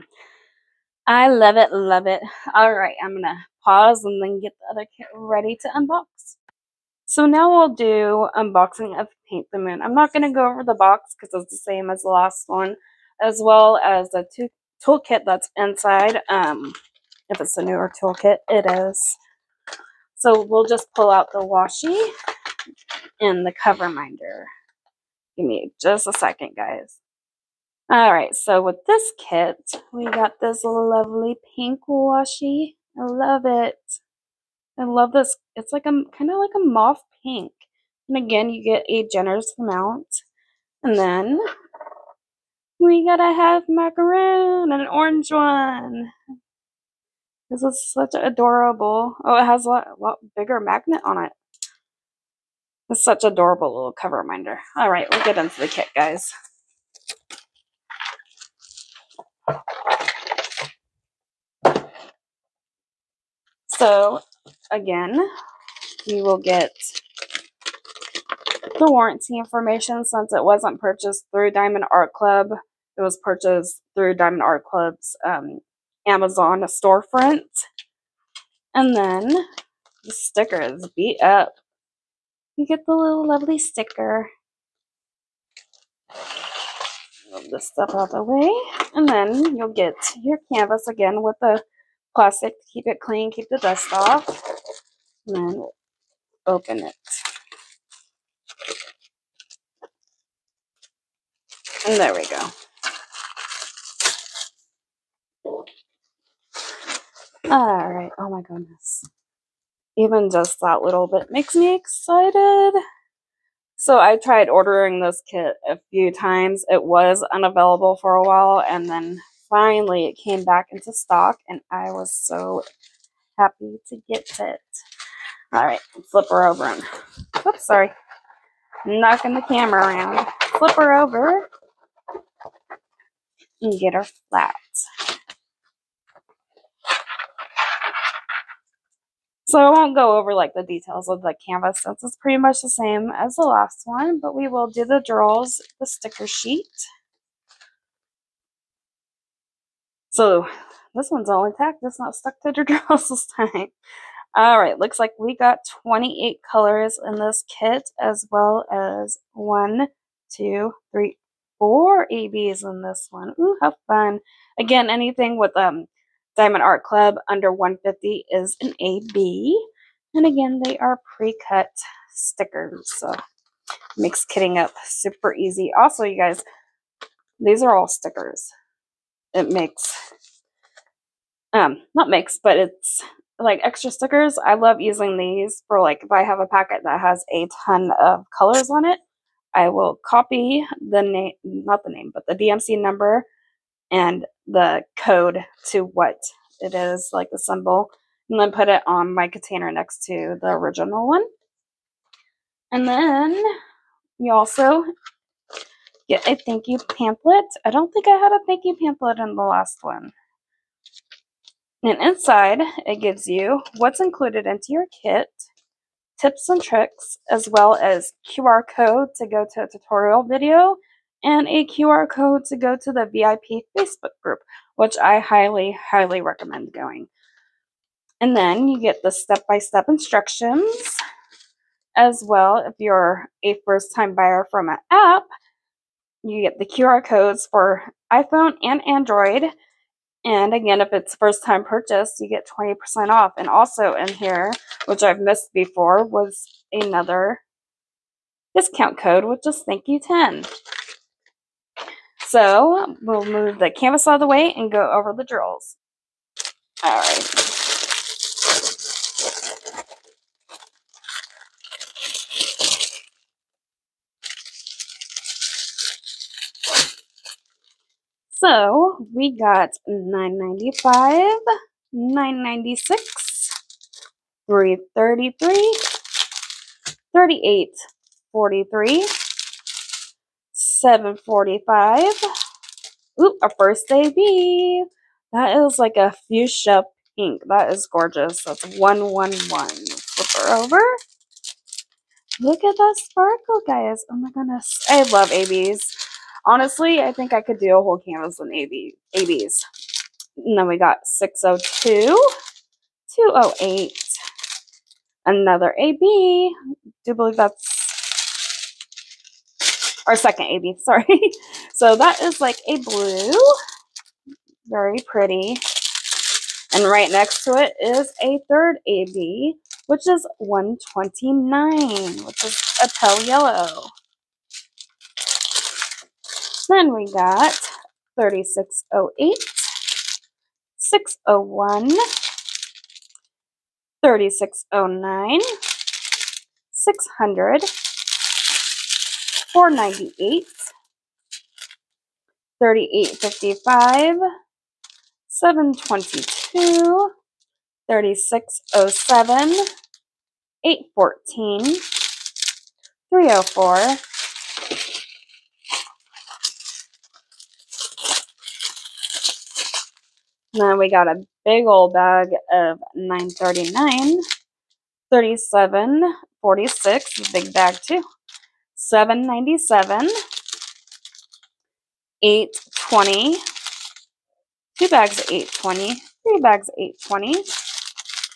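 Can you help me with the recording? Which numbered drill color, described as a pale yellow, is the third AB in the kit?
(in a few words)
129.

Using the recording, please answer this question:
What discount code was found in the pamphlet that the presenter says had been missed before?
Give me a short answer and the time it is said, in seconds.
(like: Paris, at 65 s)
thank you 10, at 249 s.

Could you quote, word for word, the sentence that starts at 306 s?
I do believe that's or second AB, sorry.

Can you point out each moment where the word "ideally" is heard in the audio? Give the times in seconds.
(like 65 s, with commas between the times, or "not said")
not said.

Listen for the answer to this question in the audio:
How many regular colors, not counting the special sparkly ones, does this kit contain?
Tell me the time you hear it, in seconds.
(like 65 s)
155 s.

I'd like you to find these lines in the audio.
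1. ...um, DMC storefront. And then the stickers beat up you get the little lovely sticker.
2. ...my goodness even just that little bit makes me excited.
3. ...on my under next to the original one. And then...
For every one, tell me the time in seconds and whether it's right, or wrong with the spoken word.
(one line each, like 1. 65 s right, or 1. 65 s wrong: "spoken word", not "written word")
1. 75 s wrong: "Amazon", not "DMC"
2. 108 s right
3. 198 s wrong: "container", not "under".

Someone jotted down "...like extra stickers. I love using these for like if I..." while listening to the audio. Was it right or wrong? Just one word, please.
right.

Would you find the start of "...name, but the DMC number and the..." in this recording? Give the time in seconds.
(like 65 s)
191 s.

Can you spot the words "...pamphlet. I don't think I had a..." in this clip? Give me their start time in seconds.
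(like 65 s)
206 s.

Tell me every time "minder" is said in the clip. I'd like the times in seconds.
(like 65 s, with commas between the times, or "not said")
23 s, 54 s.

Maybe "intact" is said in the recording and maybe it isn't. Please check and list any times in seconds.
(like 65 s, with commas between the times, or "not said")
151 s.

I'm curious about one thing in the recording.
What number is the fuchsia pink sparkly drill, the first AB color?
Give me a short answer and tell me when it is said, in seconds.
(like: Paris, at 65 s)
111, at 288 s.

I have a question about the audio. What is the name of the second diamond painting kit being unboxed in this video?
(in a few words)
Paint the Moon.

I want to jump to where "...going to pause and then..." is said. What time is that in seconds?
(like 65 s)
3 s.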